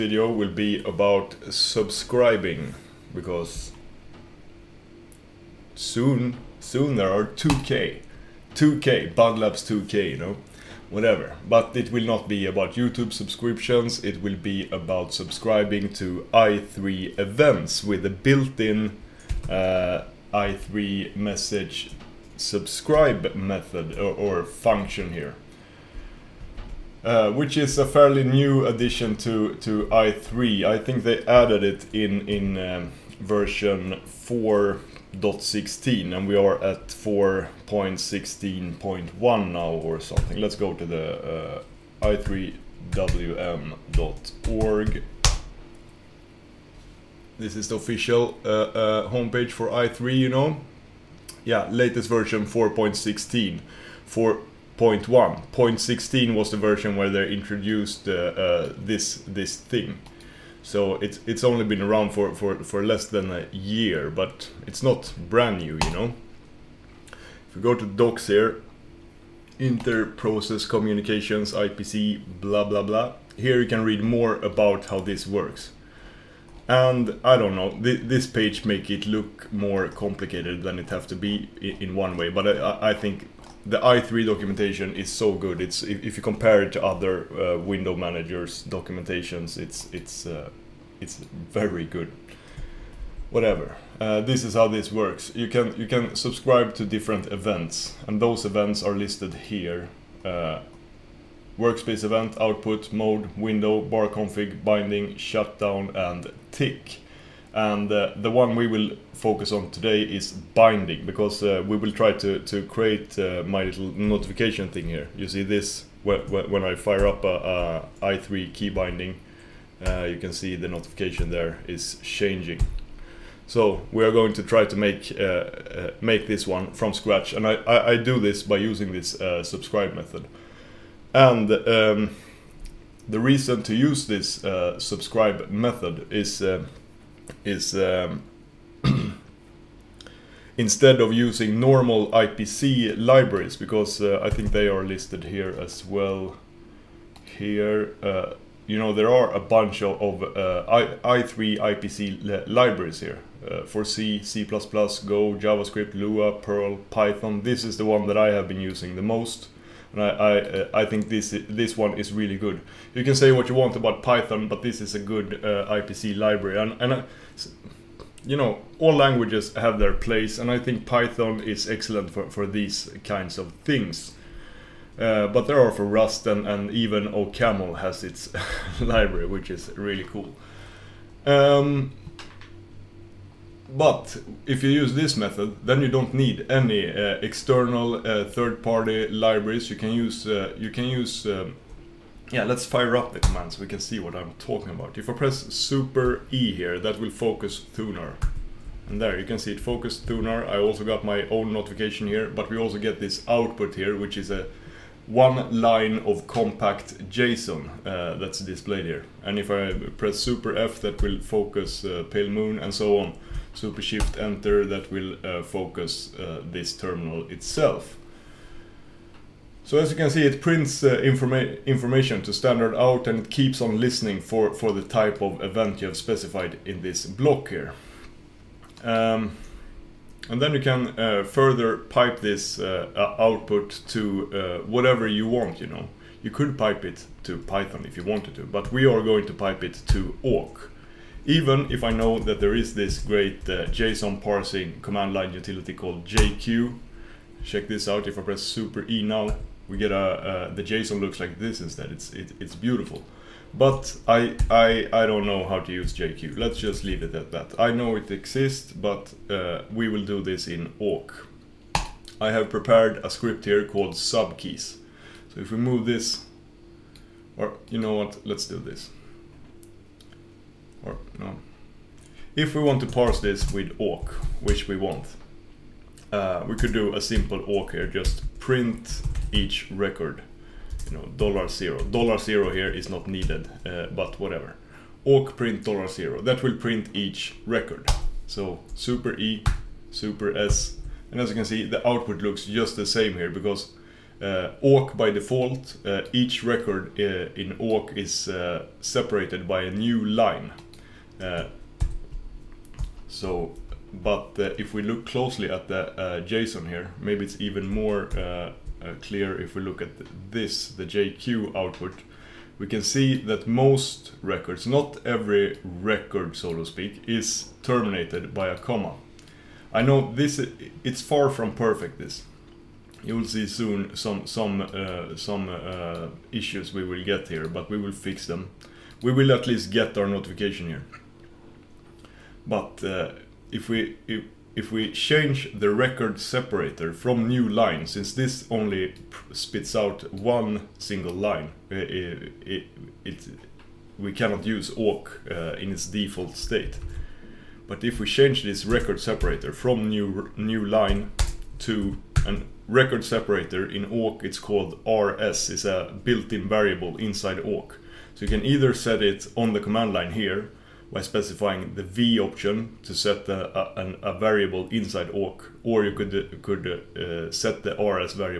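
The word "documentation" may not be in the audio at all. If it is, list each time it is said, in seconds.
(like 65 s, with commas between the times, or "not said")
84 s, 88 s.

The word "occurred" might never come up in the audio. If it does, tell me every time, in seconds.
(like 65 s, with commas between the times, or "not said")
not said.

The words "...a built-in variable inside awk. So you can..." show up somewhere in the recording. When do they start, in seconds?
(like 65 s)
355 s.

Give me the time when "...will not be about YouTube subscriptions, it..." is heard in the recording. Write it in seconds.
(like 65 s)
11 s.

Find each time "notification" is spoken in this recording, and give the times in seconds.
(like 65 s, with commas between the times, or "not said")
113 s, 120 s, 201 s, 330 s.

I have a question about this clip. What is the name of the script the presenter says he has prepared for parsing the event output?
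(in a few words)
subkeys.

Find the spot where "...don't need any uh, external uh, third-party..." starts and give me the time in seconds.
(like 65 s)
185 s.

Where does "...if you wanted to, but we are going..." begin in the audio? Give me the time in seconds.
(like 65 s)
237 s.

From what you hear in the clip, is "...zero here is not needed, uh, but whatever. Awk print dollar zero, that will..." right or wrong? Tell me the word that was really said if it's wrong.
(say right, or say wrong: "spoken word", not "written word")
right.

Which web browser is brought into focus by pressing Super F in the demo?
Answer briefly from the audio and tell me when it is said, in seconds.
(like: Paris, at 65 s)
Pale Moon, at 210 s.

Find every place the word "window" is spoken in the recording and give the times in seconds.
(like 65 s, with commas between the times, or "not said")
87 s, 103 s.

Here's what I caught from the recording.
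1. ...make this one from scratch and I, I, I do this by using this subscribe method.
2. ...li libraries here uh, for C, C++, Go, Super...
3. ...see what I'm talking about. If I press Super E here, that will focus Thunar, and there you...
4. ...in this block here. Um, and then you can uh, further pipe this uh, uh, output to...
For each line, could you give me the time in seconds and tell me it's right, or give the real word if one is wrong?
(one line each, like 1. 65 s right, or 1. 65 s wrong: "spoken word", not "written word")
1. 126 s right
2. 152 s wrong: "JavaScript", not "Super"
3. 193 s right
4. 226 s right.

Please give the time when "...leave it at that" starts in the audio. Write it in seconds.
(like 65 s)
256 s.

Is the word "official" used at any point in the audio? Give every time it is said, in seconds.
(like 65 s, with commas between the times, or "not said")
47 s.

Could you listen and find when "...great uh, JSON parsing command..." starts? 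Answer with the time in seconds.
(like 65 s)
242 s.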